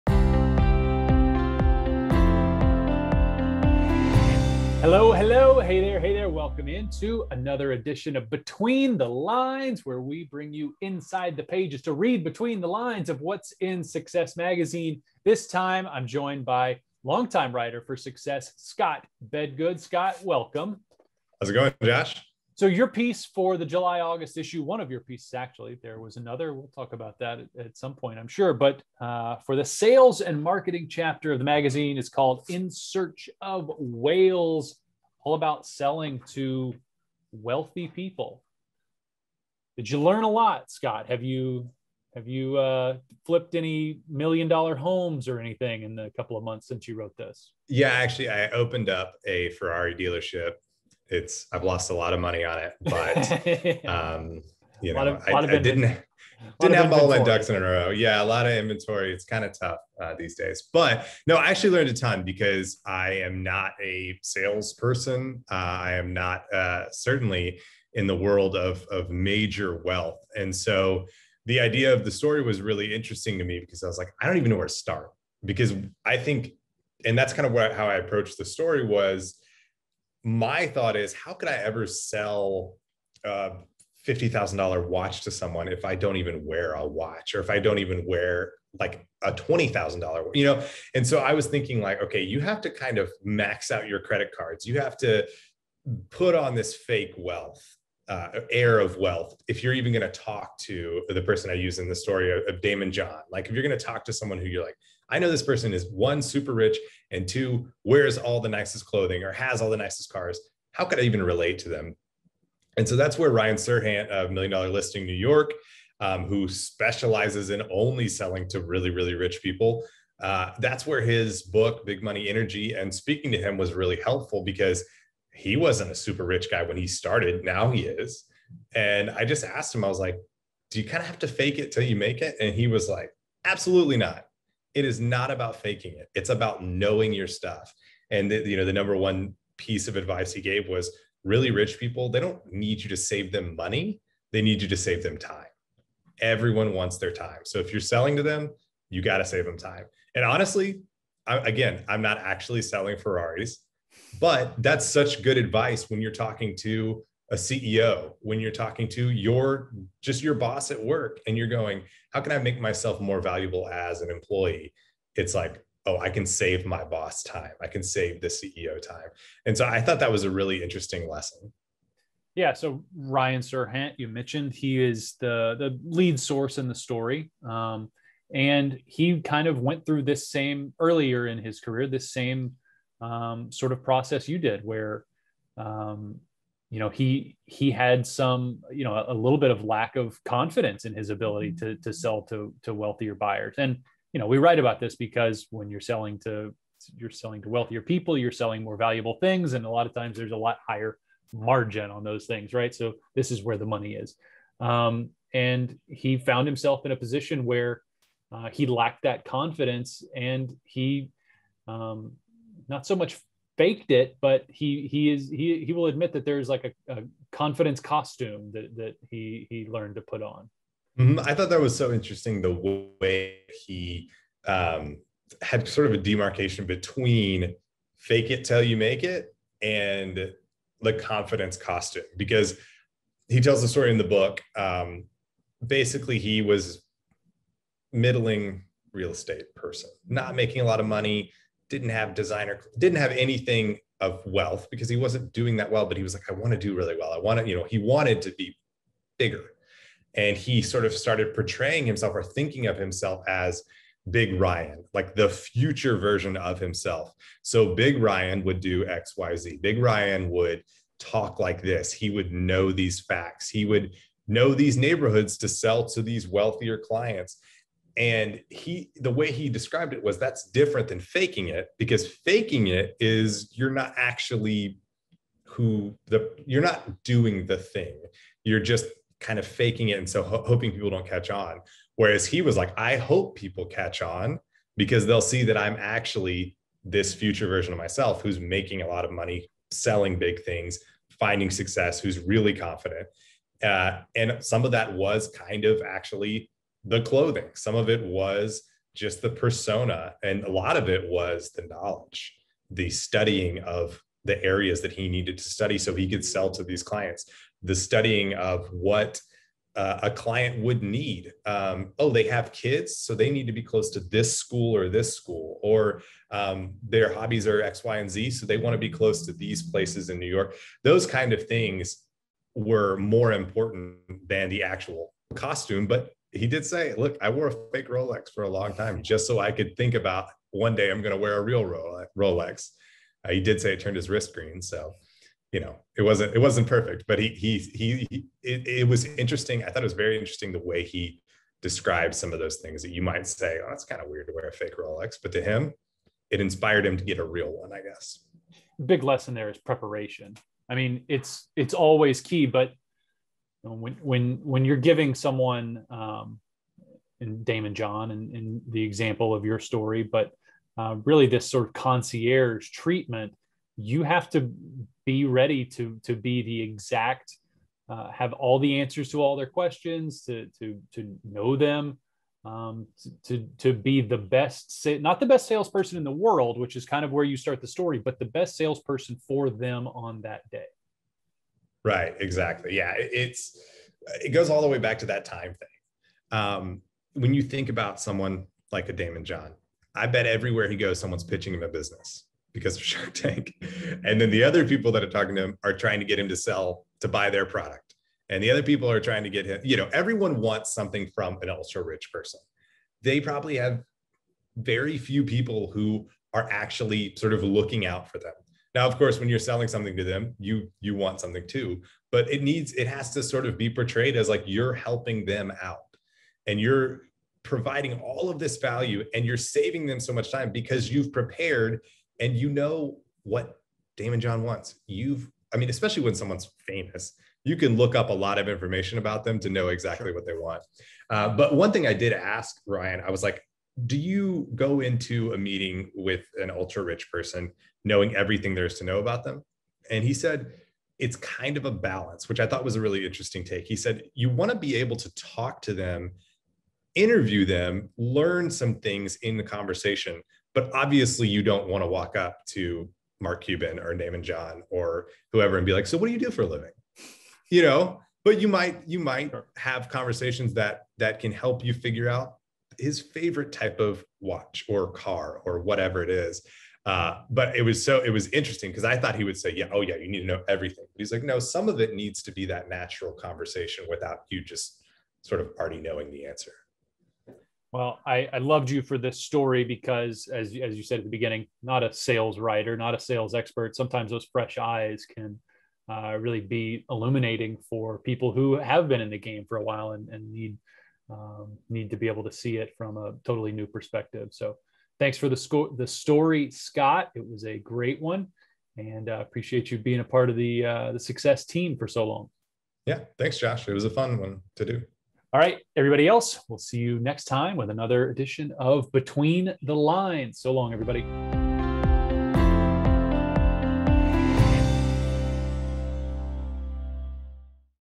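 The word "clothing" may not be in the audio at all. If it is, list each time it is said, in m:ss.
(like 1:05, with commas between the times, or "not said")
1:48, 4:57.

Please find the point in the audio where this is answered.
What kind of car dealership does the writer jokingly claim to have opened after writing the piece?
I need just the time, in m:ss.
0:49.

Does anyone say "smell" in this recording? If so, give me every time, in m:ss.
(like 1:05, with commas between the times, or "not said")
not said.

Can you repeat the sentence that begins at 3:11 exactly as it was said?
to, to sell to, to wealthier buyers.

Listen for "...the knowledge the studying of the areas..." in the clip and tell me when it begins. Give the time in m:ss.
5:01.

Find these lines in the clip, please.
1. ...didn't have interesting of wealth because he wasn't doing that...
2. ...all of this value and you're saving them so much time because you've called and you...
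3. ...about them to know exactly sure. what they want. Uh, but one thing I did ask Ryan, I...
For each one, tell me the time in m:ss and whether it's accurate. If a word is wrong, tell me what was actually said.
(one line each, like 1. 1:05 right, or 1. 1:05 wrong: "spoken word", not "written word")
1. 4:02 wrong: "anything", not "interesting"
2. 6:57 wrong: "prepared", not "called"
3. 7:08 right.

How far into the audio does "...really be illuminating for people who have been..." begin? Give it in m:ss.
8:06.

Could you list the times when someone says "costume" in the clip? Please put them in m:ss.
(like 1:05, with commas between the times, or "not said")
3:37, 3:51, 5:25.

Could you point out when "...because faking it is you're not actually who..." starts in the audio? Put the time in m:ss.
4:31.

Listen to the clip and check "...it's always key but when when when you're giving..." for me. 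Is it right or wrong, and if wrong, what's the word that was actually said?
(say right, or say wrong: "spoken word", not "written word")
right.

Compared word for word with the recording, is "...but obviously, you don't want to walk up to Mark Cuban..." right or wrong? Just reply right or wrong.
right.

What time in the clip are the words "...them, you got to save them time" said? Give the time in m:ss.
2:28.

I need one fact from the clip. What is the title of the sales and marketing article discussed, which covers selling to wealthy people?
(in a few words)
In Search of Whales.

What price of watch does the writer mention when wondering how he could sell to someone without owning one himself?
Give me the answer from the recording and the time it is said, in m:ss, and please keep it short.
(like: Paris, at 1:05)
$50,000, at 1:24.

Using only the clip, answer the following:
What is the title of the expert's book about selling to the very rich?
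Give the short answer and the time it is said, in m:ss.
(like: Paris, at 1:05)
Big Money Energy, at 2:01.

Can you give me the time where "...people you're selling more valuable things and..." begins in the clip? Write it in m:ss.
3:17.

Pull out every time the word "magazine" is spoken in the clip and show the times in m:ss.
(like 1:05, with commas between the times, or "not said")
0:14, 0:31.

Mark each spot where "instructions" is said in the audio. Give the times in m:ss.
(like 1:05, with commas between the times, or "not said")
not said.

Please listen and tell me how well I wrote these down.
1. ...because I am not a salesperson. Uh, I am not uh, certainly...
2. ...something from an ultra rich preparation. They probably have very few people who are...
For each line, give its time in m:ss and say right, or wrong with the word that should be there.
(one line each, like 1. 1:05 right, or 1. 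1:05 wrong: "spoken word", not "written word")
1. 1:02 right
2. 6:40 wrong: "person", not "preparation".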